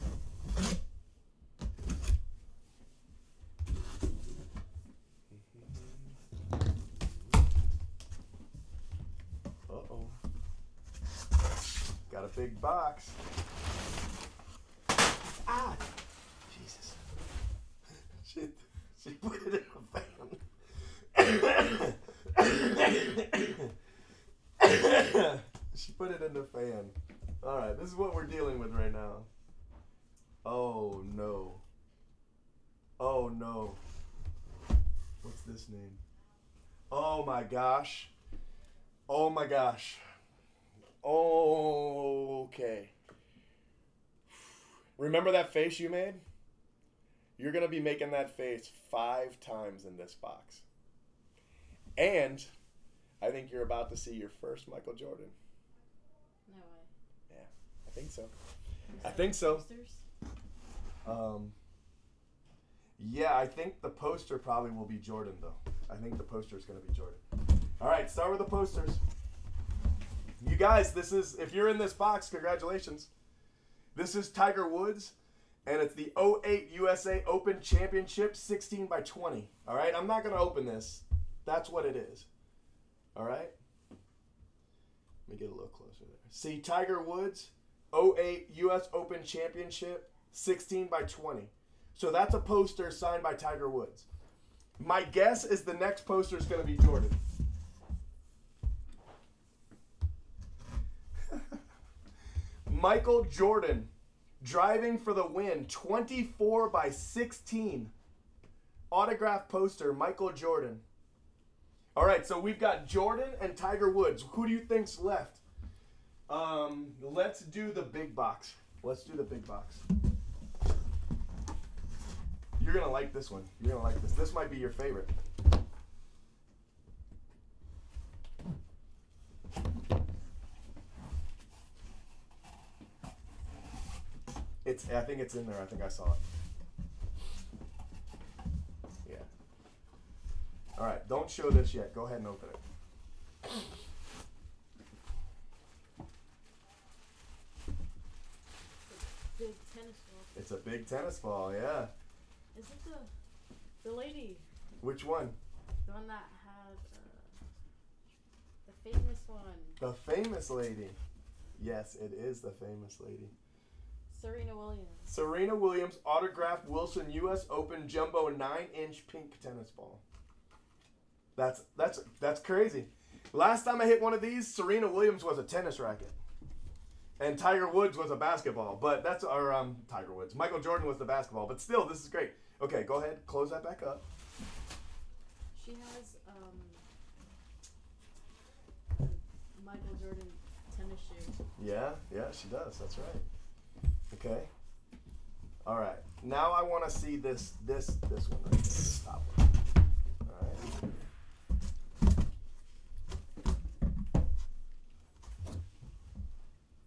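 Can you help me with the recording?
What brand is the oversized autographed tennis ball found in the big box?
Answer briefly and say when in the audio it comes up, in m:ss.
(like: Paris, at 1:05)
Wilson, at 2:46.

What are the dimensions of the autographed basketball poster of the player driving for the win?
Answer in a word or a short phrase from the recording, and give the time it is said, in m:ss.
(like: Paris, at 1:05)
24 by 16, at 1:45.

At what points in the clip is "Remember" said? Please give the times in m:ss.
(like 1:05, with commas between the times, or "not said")
0:44.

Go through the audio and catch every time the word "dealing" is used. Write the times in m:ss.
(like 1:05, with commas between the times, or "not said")
0:28.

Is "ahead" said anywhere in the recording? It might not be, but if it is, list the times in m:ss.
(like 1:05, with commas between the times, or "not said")
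2:22, 3:02.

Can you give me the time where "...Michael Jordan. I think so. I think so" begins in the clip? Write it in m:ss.
0:54.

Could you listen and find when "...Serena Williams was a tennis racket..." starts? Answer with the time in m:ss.
2:54.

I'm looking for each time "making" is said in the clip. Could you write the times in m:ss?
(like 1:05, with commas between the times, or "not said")
0:47.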